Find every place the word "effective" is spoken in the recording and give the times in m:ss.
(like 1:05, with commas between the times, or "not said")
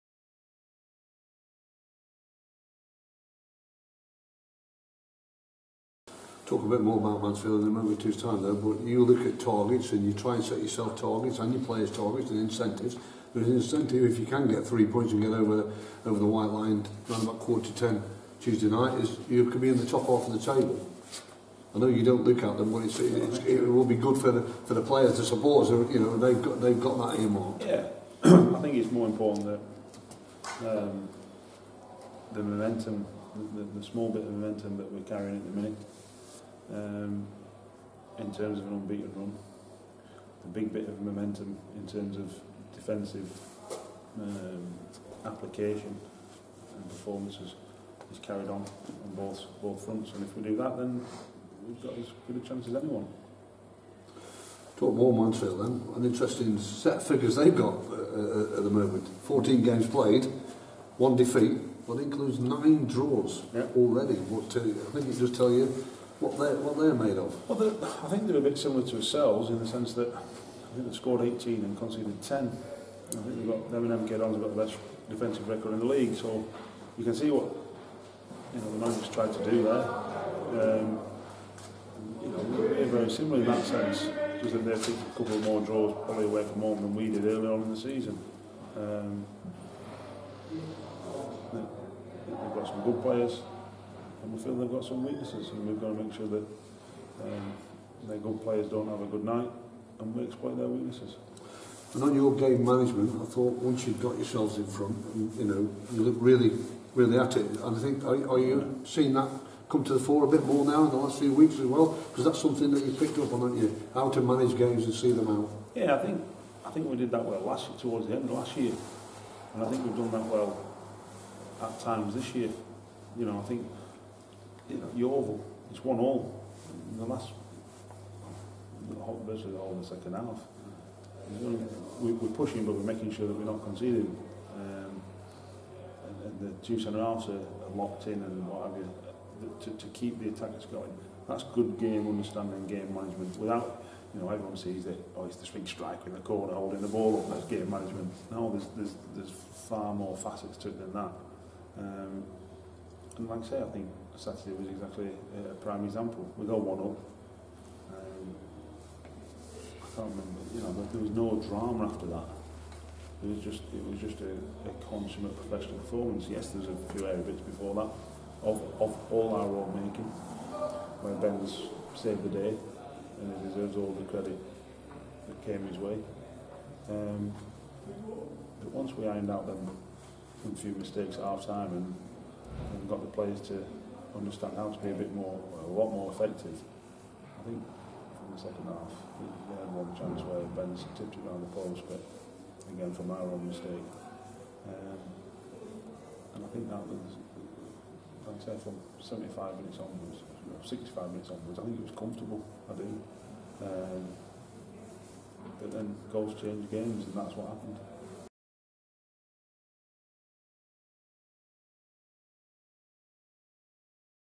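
3:06.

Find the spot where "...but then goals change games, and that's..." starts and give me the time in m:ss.
3:25.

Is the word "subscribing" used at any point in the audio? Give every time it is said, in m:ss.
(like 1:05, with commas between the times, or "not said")
not said.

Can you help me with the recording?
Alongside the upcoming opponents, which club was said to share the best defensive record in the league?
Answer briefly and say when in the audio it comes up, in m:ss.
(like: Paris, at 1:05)
MK Dons, at 1:14.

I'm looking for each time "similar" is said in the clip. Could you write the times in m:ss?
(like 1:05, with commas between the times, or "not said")
1:08, 1:23.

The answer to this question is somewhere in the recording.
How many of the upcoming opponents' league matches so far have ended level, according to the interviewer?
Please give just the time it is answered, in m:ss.
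1:02.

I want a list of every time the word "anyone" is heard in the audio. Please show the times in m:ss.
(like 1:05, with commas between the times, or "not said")
0:52.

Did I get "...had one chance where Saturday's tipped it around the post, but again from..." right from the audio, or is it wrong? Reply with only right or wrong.
wrong.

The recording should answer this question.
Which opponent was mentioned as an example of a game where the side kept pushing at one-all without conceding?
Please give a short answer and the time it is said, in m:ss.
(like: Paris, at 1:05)
Yeovil, at 2:04.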